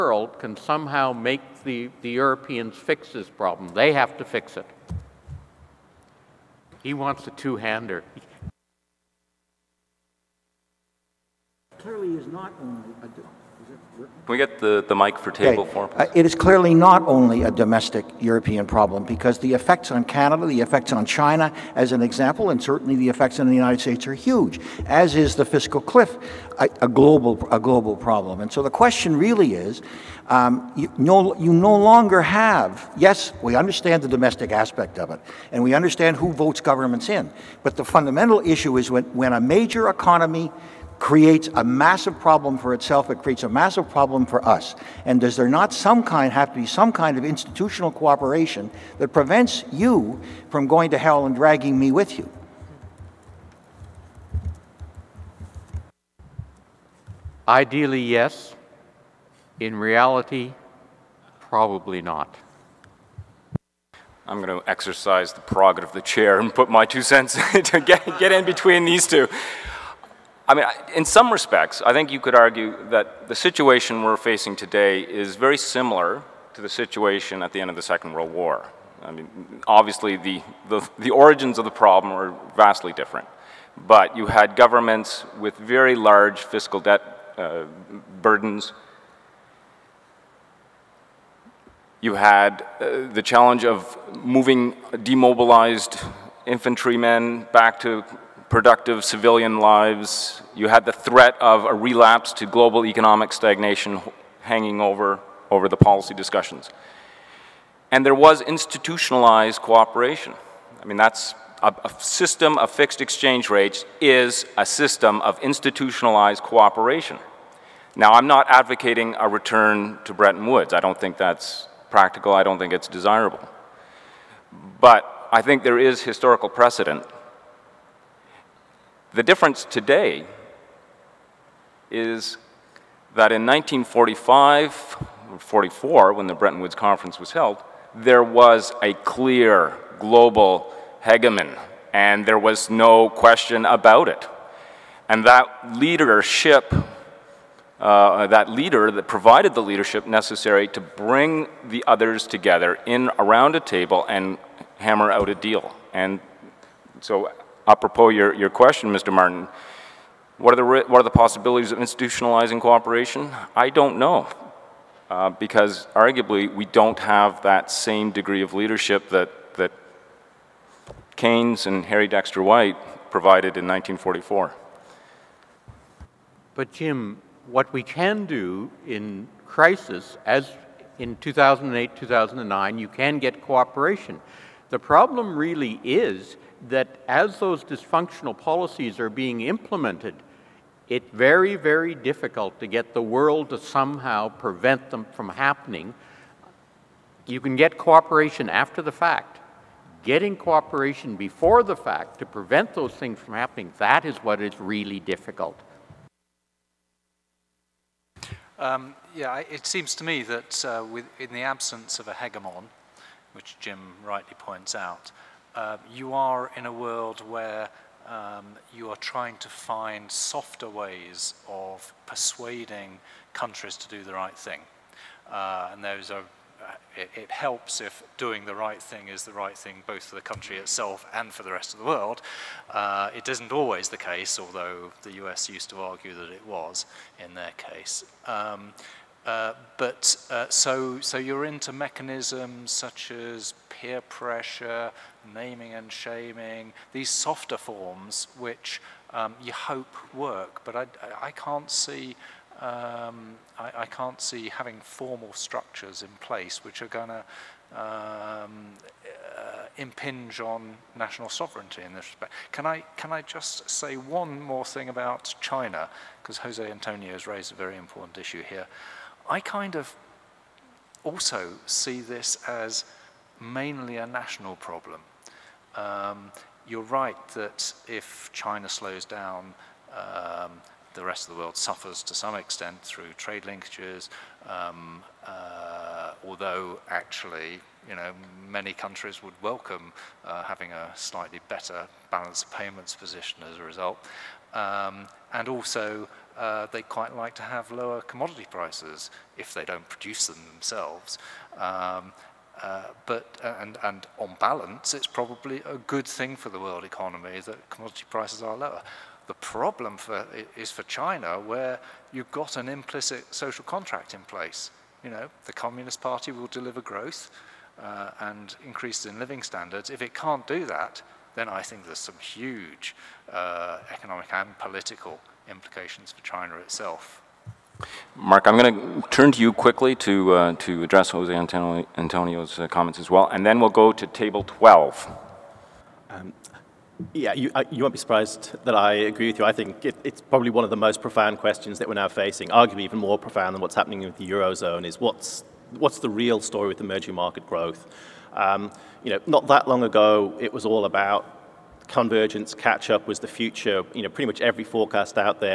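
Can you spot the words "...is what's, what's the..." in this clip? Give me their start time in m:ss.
5:44.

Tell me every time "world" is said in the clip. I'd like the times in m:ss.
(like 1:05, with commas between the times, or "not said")
1:18, 3:13, 3:36, 3:51, 4:41, 5:06.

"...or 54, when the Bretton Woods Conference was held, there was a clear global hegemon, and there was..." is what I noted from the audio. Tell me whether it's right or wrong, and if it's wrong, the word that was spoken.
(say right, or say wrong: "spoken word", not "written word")
wrong: "44", not "54".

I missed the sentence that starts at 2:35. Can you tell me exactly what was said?
And so apropos your, your question, Mr.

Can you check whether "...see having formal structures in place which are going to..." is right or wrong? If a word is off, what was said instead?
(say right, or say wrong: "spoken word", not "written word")
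right.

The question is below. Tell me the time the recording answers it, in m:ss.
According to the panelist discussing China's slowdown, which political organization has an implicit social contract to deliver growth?
5:15.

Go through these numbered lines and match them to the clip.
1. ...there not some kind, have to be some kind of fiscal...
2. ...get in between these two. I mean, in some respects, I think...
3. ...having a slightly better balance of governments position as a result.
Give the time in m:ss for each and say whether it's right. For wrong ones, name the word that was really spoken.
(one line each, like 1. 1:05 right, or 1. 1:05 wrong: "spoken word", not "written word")
1. 0:45 wrong: "institutional", not "fiscal"
2. 1:08 right
3. 4:50 wrong: "payments", not "governments".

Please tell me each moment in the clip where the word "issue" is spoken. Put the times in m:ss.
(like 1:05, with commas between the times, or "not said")
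0:38, 4:28.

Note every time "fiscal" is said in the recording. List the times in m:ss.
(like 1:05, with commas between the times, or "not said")
0:25, 1:26.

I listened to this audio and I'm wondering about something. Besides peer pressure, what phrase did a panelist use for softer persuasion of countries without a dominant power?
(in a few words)
naming and shaming.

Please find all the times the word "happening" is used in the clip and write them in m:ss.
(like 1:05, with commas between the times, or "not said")
3:15, 3:23, 5:43.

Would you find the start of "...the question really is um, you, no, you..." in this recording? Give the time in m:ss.
0:28.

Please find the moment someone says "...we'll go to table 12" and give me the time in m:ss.
5:33.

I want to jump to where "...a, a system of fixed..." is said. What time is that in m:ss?
1:51.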